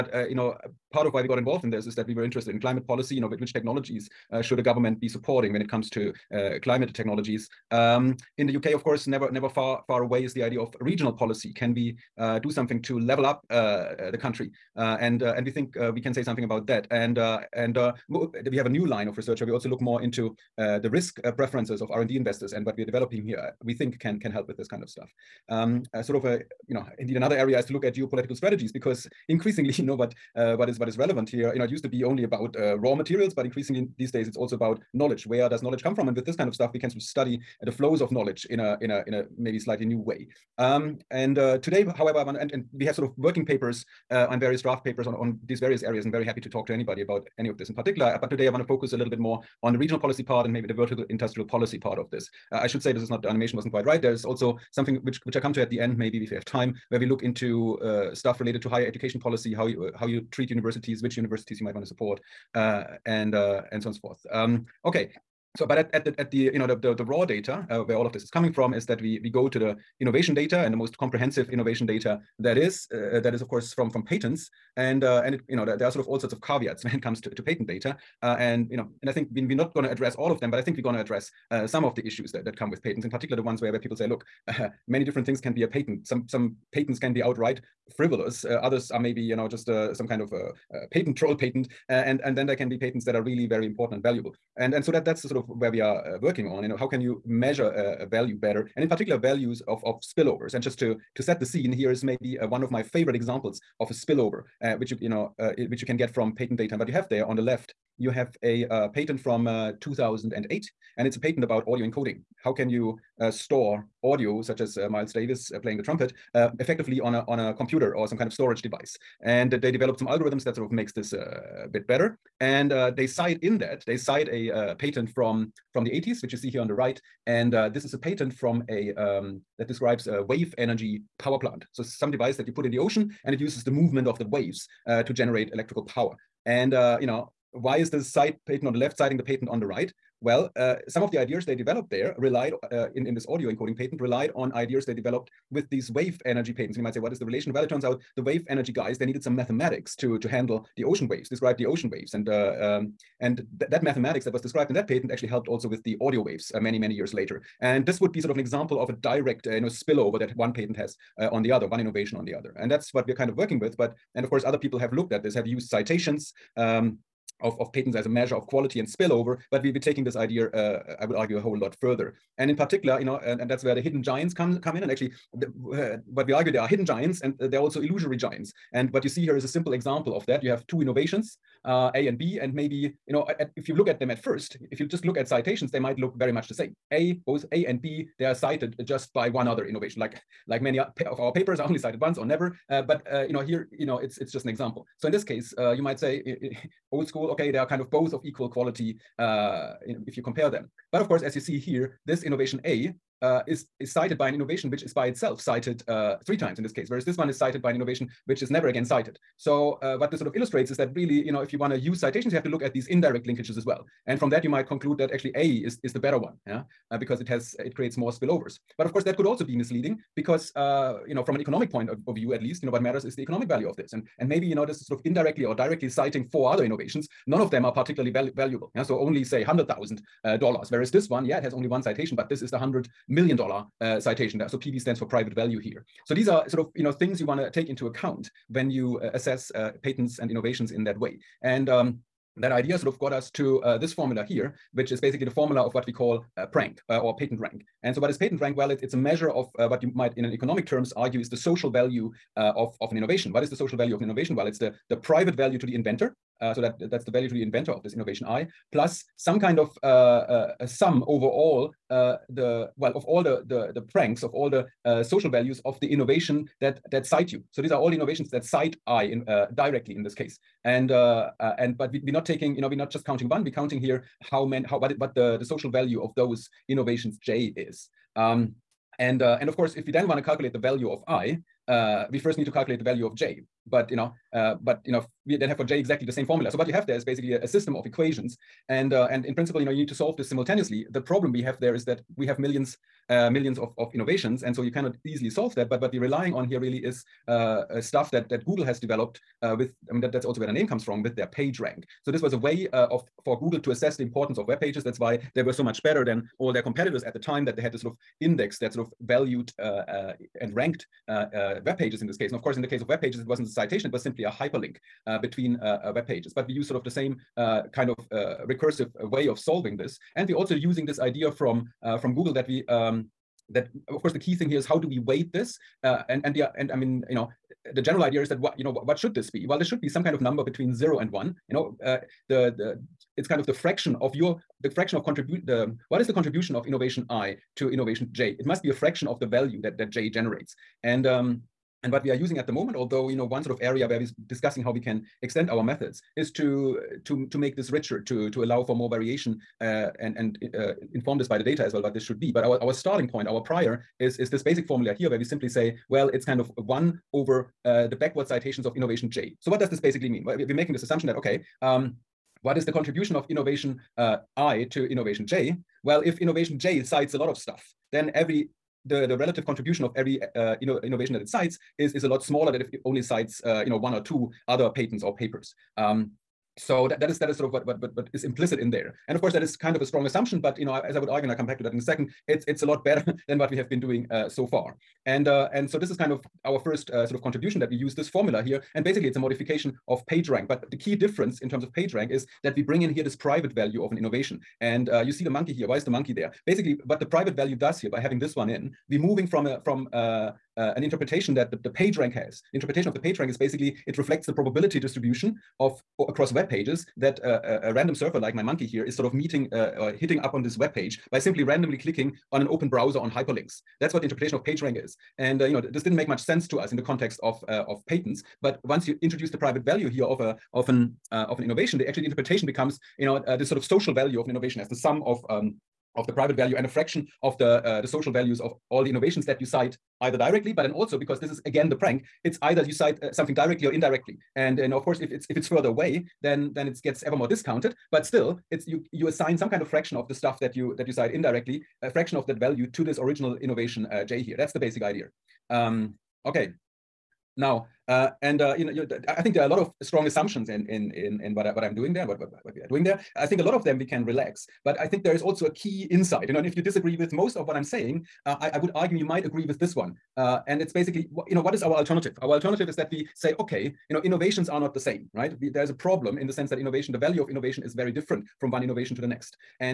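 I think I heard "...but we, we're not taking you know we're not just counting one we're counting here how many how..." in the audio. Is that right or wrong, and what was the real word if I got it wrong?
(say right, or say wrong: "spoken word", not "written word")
right.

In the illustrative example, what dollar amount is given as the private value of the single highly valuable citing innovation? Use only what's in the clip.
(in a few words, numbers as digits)
$100 million.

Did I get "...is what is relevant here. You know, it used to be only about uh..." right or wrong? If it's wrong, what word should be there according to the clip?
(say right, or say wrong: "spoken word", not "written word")
right.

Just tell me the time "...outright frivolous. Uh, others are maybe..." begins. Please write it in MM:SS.
01:27.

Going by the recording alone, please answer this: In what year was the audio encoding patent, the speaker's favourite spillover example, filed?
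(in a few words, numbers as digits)
2008.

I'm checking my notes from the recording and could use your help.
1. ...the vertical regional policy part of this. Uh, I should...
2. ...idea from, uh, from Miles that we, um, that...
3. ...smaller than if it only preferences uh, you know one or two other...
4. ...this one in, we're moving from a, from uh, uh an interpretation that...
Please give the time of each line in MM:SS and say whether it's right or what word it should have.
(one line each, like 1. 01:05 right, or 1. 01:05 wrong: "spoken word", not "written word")
1. 00:50 wrong: "industrial", not "regional"
2. 05:20 wrong: "Google", not "Miles"
3. 06:12 wrong: "cites", not "preferences"
4. 06:38 right.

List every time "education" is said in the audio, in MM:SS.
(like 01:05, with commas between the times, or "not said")
00:58.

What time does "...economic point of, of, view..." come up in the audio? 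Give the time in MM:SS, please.
03:41.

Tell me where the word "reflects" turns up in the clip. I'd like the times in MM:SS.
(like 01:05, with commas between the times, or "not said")
06:43.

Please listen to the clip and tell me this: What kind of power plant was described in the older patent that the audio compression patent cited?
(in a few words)
Wave energy power plant.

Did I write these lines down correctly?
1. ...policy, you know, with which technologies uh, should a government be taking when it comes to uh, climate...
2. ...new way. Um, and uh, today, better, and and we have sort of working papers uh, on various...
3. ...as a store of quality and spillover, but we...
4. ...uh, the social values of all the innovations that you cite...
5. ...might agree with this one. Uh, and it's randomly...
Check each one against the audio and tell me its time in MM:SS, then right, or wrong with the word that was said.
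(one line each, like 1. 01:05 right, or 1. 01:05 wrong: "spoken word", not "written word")
1. 00:02 wrong: "supporting", not "taking"
2. 00:39 wrong: "however", not "better"
3. 02:47 wrong: "measure", not "store"
4. 07:07 right
5. 07:39 wrong: "basically", not "randomly".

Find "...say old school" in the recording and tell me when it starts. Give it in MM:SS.
03:15.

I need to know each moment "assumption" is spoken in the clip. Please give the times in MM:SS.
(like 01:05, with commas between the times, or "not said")
06:00, 06:20, 07:30.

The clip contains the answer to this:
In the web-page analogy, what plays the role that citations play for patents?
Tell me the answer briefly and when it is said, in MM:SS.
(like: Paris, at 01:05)
A hyperlink, at 05:14.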